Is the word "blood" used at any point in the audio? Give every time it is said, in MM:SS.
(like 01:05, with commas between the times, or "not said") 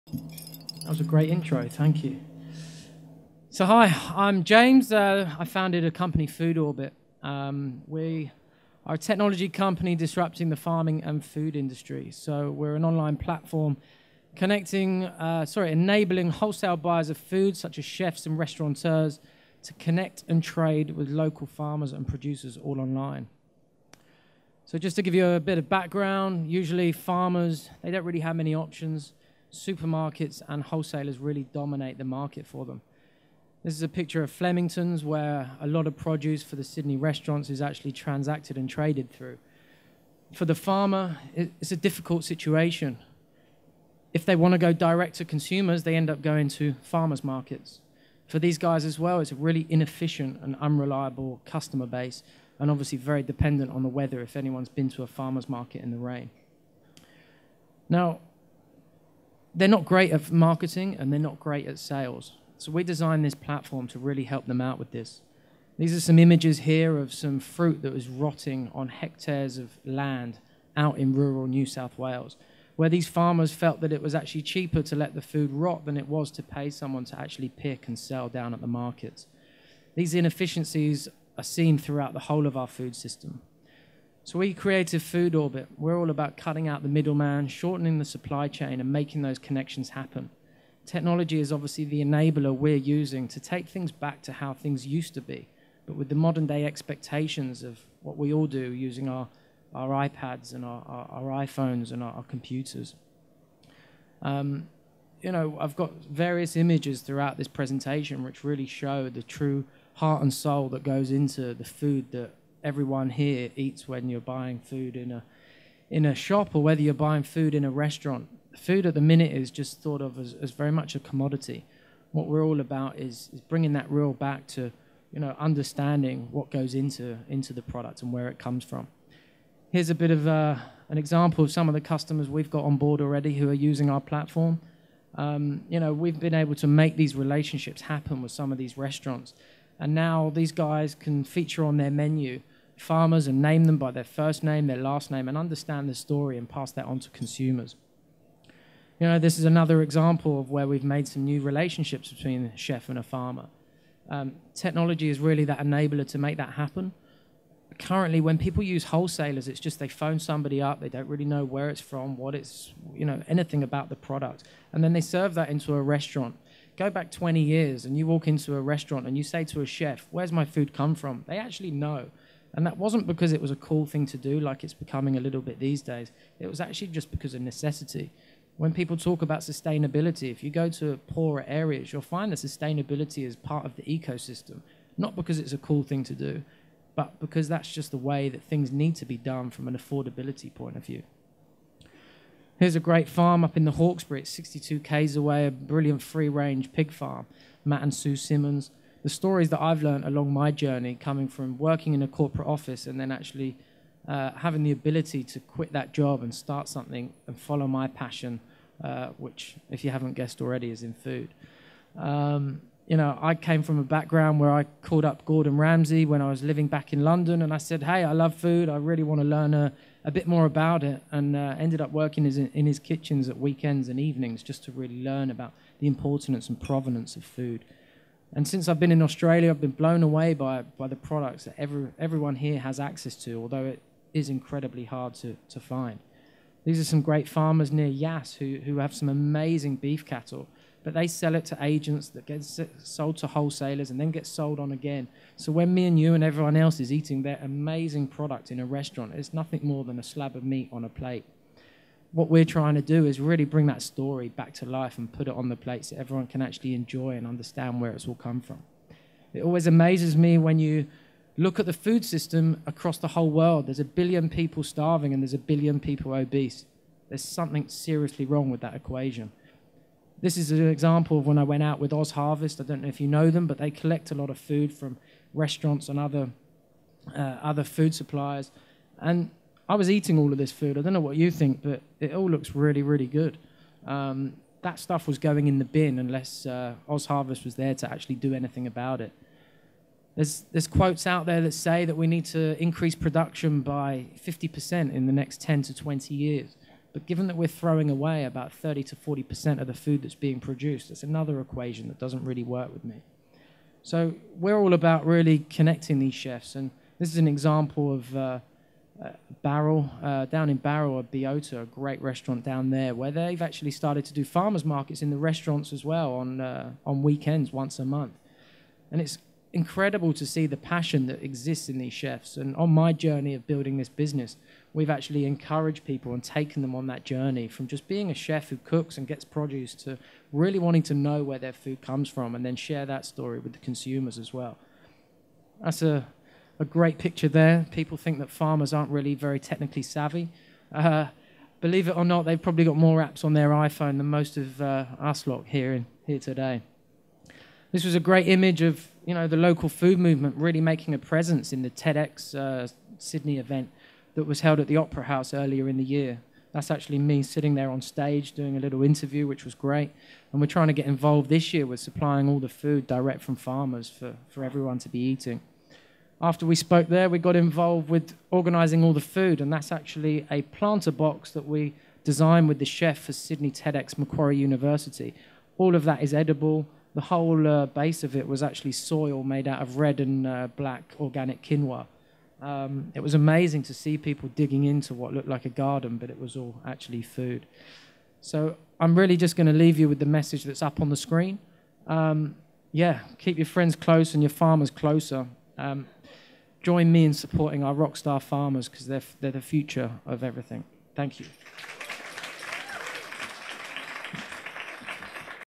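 not said.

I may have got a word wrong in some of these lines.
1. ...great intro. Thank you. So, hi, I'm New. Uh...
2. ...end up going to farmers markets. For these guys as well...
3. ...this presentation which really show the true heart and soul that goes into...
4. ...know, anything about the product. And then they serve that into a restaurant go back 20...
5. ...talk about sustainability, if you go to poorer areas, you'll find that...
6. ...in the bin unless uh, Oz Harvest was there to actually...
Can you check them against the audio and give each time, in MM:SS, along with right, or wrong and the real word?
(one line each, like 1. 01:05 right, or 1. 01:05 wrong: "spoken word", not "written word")
1. 00:01 wrong: "James", not "New"
2. 00:45 right
3. 01:47 right
4. 02:43 right
5. 02:58 right
6. 04:45 right.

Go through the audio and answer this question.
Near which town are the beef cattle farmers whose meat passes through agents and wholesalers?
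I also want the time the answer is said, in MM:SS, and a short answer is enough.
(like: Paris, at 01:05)
Yass, at 03:57.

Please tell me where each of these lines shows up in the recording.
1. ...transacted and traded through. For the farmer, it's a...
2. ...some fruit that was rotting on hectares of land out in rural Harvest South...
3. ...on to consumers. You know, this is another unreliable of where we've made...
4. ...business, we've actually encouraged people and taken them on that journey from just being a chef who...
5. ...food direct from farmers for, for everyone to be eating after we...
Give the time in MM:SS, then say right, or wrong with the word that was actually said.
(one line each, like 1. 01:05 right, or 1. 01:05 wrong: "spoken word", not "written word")
1. 00:37 right
2. 01:07 wrong: "New", not "Harvest"
3. 02:26 wrong: "example", not "unreliable"
4. 05:23 right
5. 06:02 right.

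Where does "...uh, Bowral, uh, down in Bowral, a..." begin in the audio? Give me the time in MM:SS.
05:08.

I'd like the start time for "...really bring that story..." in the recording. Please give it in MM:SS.
04:13.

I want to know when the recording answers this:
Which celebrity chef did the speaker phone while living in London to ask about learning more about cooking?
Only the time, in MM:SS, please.
03:35.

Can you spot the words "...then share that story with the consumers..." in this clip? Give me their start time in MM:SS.
05:32.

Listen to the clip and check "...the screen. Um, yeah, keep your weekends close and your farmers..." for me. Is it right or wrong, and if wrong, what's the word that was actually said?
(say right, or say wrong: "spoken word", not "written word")
wrong: "friends", not "weekends".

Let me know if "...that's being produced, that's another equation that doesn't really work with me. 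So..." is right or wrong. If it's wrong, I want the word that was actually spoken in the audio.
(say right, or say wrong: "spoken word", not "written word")
right.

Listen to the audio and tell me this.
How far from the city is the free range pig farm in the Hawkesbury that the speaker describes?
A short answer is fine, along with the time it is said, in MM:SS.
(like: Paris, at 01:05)
62 km, at 03:14.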